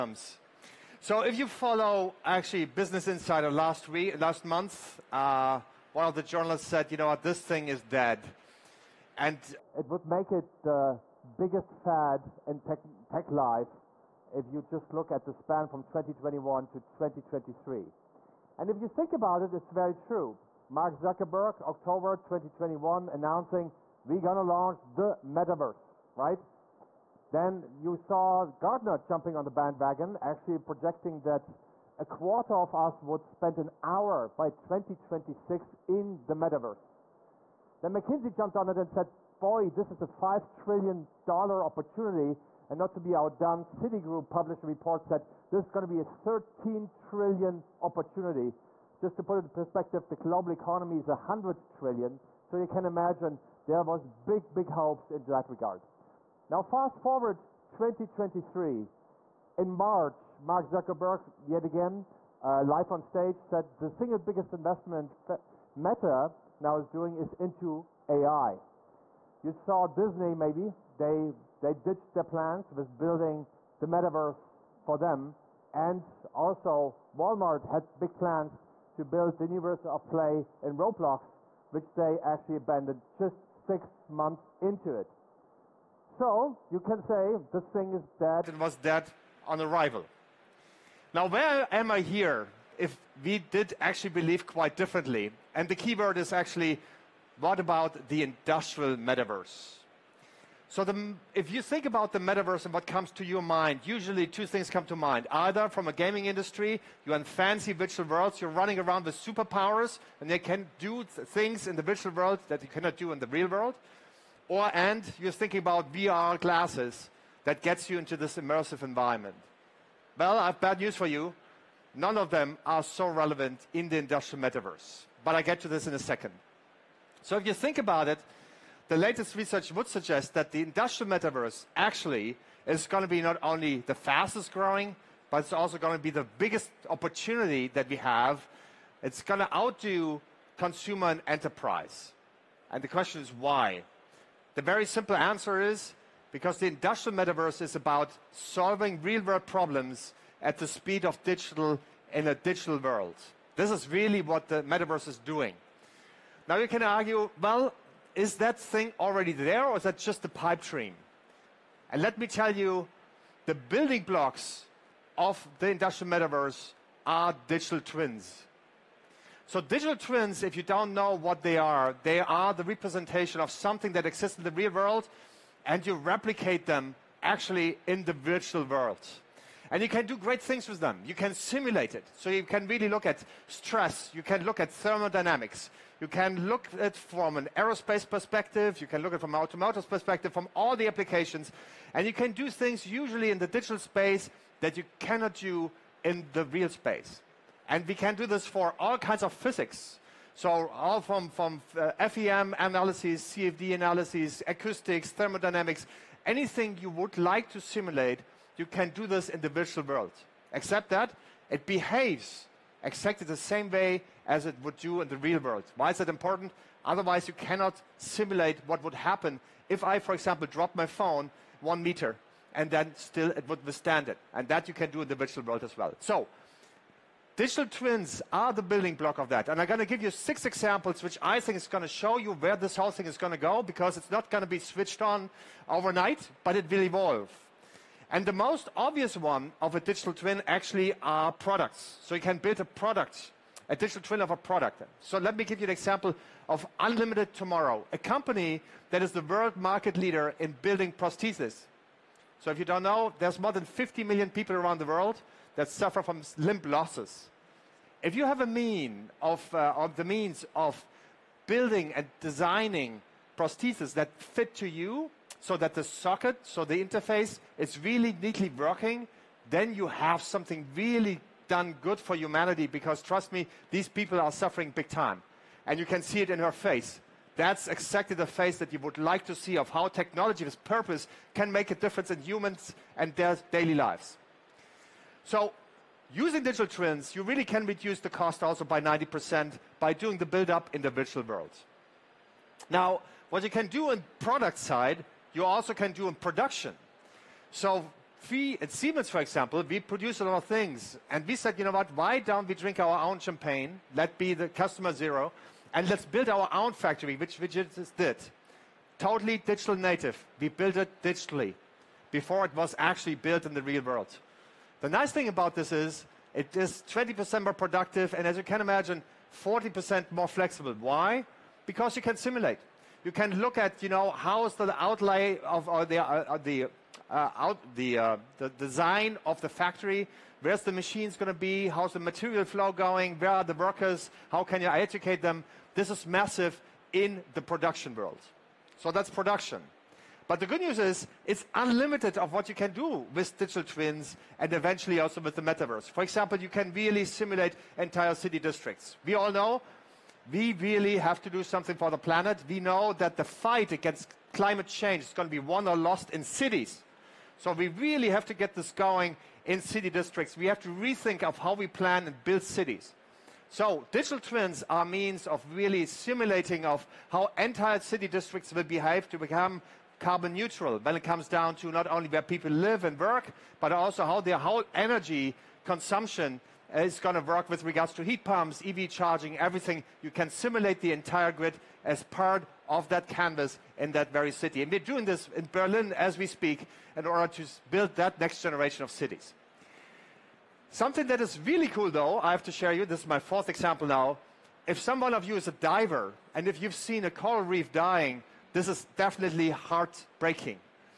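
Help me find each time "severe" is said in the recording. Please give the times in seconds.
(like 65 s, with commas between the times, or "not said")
not said.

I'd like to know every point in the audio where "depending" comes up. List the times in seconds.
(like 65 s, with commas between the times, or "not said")
not said.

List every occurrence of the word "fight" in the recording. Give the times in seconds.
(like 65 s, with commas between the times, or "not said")
353 s.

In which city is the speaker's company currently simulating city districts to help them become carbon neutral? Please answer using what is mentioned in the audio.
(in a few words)
Berlin.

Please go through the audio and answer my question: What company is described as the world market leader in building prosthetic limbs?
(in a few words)
Unlimited Tomorrow.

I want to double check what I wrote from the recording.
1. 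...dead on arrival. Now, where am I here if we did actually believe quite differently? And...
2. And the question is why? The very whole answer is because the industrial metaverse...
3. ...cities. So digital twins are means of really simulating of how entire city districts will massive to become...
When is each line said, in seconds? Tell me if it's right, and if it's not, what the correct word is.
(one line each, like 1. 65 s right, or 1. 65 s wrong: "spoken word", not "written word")
1. 88 s right
2. 142 s wrong: "simple", not "whole"
3. 362 s wrong: "behave", not "massive".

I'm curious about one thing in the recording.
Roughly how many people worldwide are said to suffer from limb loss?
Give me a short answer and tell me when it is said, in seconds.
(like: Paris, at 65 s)
50 million, at 253 s.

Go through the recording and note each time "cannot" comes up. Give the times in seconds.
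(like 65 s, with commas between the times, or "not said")
112 s, 194 s, 217 s.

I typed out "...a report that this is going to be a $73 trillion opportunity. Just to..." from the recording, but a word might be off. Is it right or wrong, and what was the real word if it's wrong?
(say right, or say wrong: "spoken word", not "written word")
wrong: "13", not "73".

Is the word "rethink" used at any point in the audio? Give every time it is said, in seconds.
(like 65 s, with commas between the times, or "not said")
360 s.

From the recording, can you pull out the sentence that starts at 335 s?
This is massive in the production world.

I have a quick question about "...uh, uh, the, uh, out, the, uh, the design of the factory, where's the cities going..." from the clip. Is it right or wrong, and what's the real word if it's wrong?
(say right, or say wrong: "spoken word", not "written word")
wrong: "machines", not "cities".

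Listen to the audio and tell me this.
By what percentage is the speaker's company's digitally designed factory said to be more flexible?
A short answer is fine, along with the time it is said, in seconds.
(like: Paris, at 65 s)
40%, at 319 s.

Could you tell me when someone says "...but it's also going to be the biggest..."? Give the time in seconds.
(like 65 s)
135 s.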